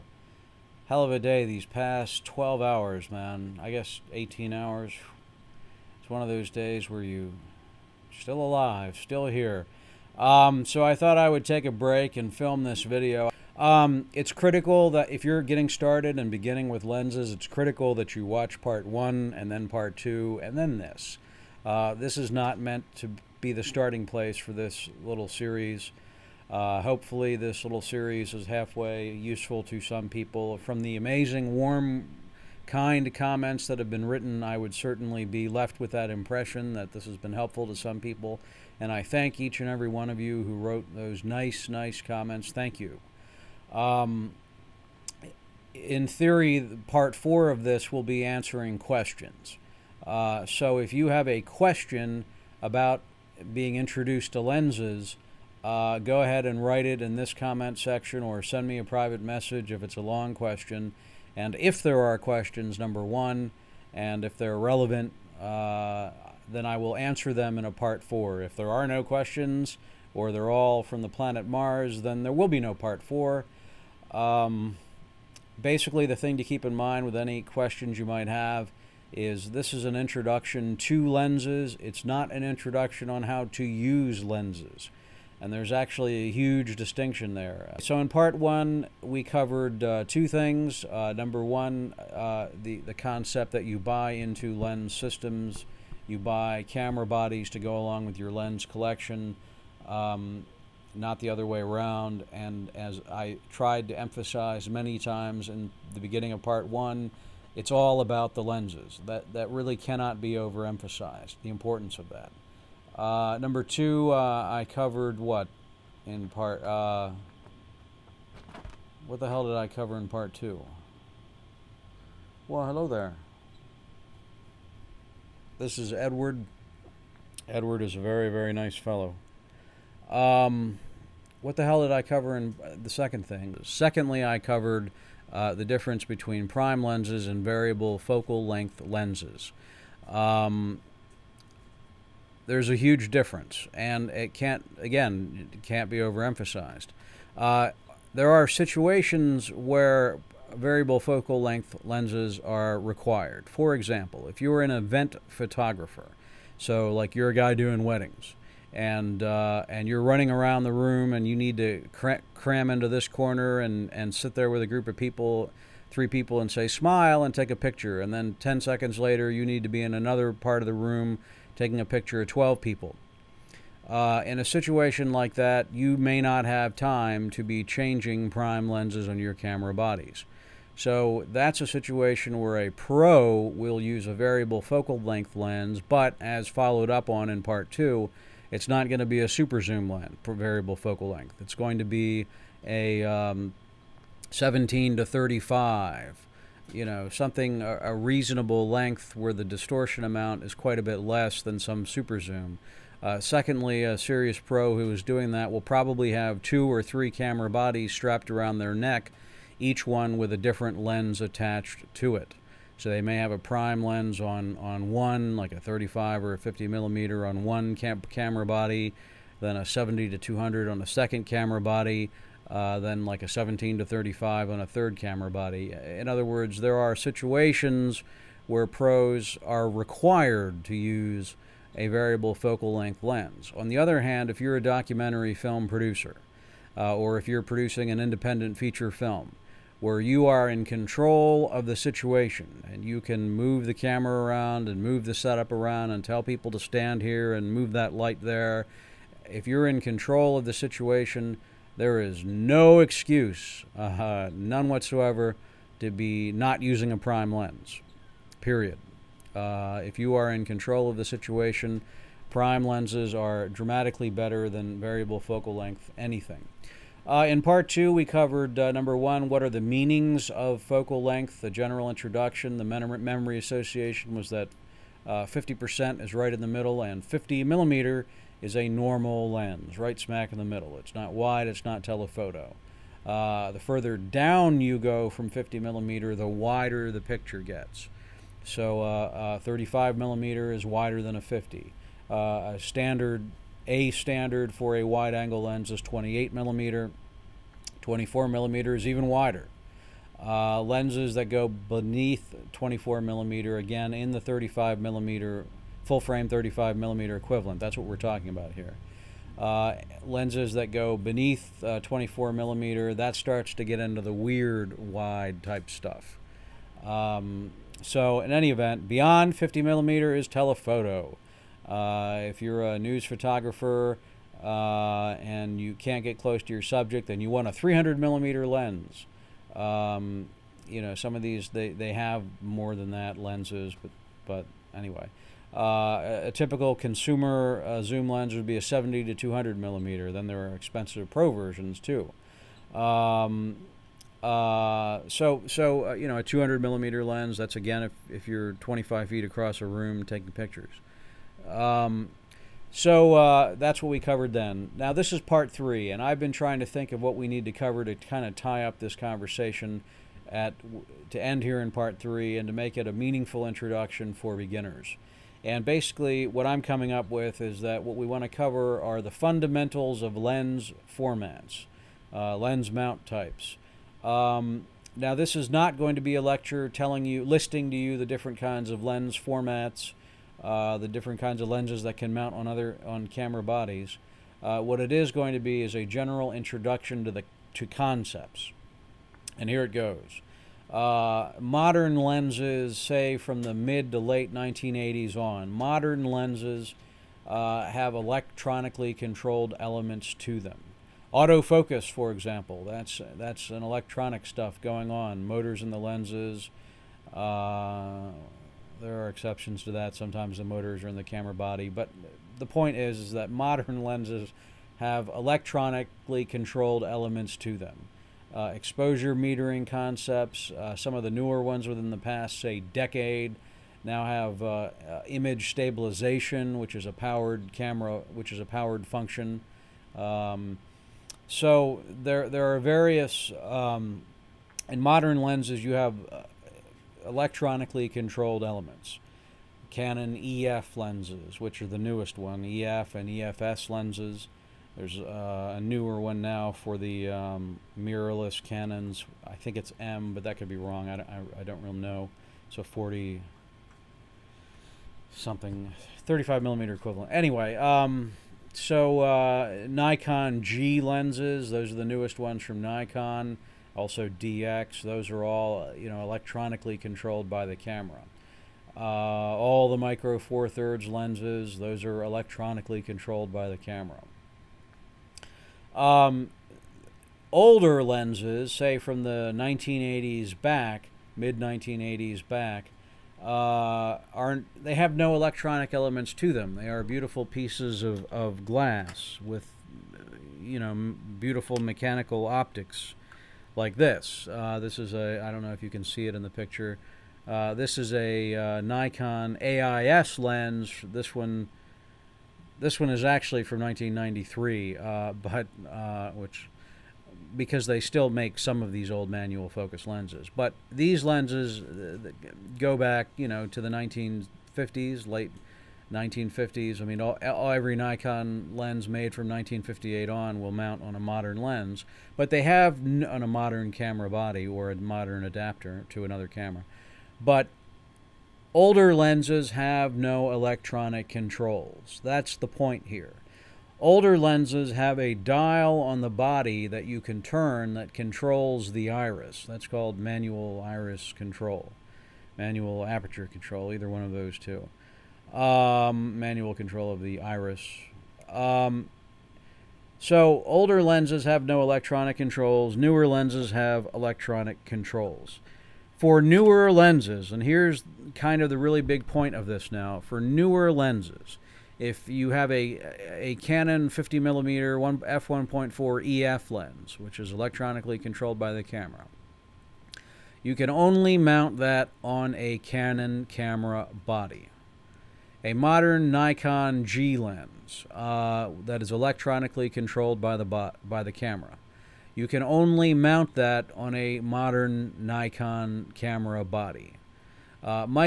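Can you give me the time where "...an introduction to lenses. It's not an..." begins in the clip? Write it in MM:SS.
01:19.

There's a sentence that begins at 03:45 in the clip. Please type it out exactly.
In other words, there are situations where pros are required to use a variable focal length lens.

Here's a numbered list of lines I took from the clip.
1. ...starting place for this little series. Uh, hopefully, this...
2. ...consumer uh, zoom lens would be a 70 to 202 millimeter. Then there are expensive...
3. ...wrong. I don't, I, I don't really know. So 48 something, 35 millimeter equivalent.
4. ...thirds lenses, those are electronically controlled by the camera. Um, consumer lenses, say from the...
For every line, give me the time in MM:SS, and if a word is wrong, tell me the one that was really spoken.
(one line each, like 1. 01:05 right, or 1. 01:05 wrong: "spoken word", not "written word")
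1. 00:23 right
2. 05:36 wrong: "200", not "202"
3. 07:30 wrong: "40", not "48"
4. 07:50 wrong: "older", not "consumer".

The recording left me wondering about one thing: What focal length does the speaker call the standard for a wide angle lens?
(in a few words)
28 millimeter.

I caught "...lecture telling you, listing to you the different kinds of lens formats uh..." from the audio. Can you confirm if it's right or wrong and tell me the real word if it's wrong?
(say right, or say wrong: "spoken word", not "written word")
right.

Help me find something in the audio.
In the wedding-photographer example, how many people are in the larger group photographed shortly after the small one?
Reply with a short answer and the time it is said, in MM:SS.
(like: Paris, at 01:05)
12, at 02:52.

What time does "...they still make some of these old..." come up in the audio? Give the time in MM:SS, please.
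08:27.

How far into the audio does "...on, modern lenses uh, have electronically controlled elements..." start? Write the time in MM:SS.
06:35.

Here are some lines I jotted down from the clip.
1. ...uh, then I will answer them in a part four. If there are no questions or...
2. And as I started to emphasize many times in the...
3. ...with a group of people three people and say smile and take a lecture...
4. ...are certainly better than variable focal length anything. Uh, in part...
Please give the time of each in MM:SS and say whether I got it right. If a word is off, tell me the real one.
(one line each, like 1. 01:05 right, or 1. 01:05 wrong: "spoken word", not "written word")
1. 01:05 right
2. 01:42 wrong: "tried", not "started"
3. 02:44 wrong: "picture", not "lecture"
4. 04:23 wrong: "dramatically", not "certainly".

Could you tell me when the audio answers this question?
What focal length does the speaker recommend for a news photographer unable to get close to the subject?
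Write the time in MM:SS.
05:27.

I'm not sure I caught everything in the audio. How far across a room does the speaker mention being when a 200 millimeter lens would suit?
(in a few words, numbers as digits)
25 feet.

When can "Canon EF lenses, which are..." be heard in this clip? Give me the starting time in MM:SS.
07:19.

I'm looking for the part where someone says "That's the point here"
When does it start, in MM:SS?
08:52.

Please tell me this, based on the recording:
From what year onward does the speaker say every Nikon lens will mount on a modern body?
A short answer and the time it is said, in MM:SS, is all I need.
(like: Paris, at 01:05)
1958, at 08:39.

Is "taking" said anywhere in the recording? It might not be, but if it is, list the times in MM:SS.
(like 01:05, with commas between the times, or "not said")
02:51, 05:50.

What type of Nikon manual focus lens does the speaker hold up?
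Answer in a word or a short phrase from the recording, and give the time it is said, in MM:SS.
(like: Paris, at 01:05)
Nikon AIS, at 08:18.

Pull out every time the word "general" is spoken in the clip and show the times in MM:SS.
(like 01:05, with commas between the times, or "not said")
04:31, 06:25.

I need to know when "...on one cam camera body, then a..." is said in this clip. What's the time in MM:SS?
03:37.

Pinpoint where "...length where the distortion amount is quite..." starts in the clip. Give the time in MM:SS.
03:18.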